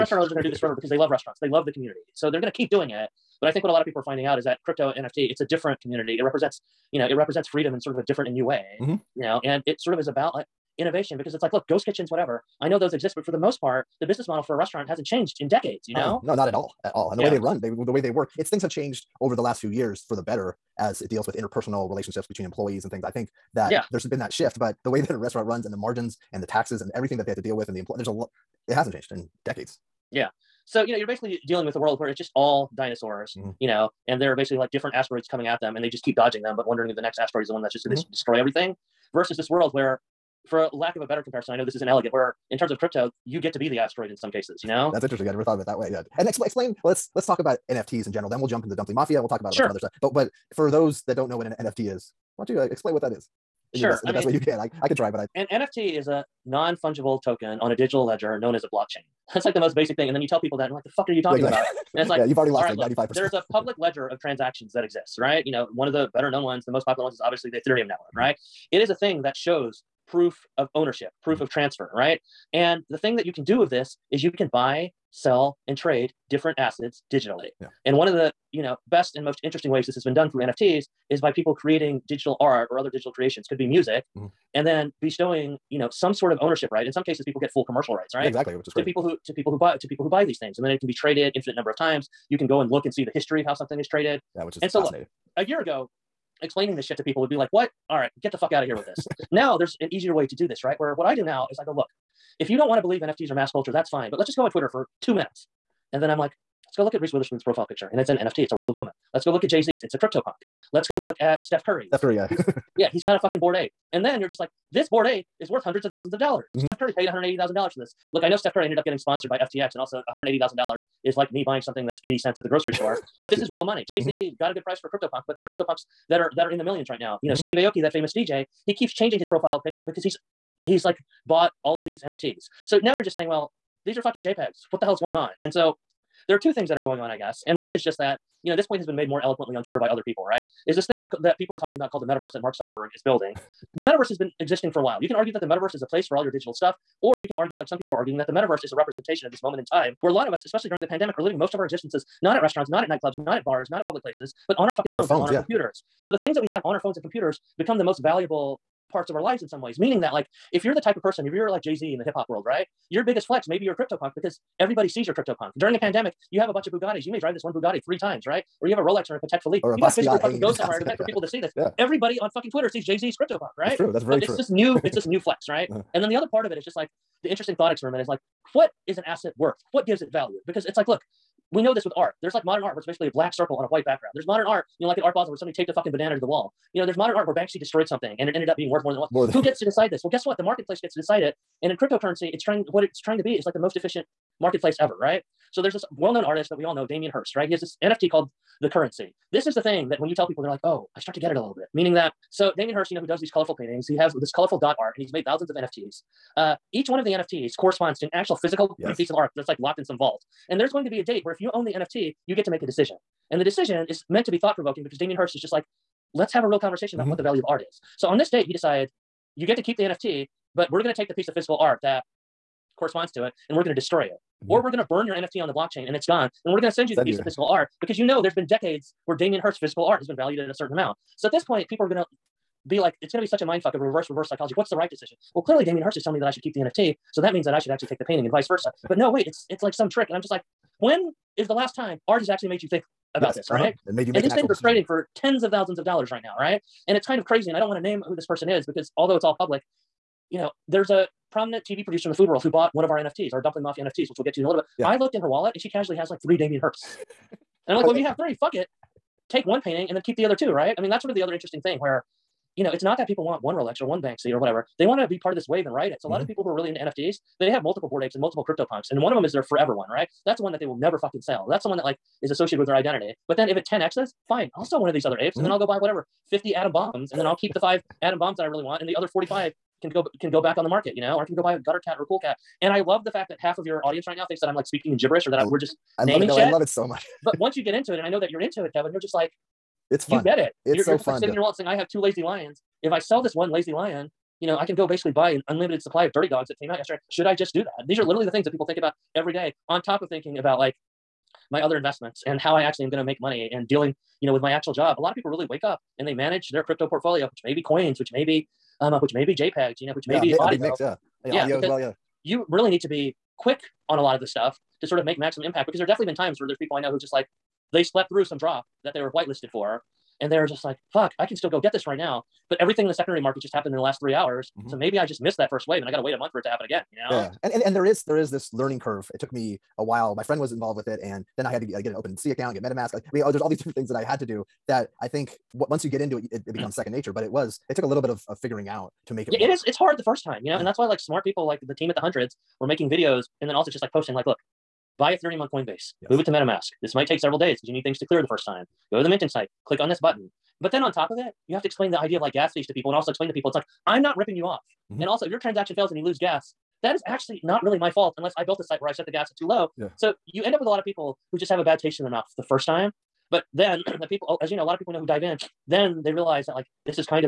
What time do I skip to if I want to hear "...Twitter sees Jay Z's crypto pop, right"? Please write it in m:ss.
2:52.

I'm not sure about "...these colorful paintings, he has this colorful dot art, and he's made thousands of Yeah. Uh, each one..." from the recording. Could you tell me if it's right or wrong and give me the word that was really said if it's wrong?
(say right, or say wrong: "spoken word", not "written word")
wrong: "NFTs", not "Yeah".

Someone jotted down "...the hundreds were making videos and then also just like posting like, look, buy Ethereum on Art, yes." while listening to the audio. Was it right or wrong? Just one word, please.
wrong.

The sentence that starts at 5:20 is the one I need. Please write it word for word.
And they're just like, fuck, I can still go get this right now.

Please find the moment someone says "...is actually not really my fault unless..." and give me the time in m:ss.
5:56.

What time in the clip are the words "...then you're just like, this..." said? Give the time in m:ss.
1:54.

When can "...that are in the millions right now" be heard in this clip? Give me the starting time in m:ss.
2:06.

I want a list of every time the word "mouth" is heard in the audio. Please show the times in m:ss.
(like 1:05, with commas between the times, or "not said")
6:02.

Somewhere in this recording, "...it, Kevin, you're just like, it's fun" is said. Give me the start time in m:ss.
4:48.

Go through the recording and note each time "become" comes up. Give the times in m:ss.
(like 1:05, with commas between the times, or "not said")
2:37, 5:36.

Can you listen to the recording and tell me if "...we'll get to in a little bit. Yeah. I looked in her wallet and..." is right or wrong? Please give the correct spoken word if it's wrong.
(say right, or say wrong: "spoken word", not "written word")
right.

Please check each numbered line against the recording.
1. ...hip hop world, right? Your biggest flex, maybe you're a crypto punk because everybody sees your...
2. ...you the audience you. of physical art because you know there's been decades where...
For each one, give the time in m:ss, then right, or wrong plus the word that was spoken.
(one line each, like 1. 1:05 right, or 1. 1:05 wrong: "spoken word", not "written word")
1. 2:42 right
2. 3:46 wrong: "piece", not "audience".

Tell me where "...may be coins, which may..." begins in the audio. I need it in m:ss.
5:07.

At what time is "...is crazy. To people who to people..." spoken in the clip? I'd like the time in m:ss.
1:28.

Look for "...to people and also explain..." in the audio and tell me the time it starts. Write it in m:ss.
5:52.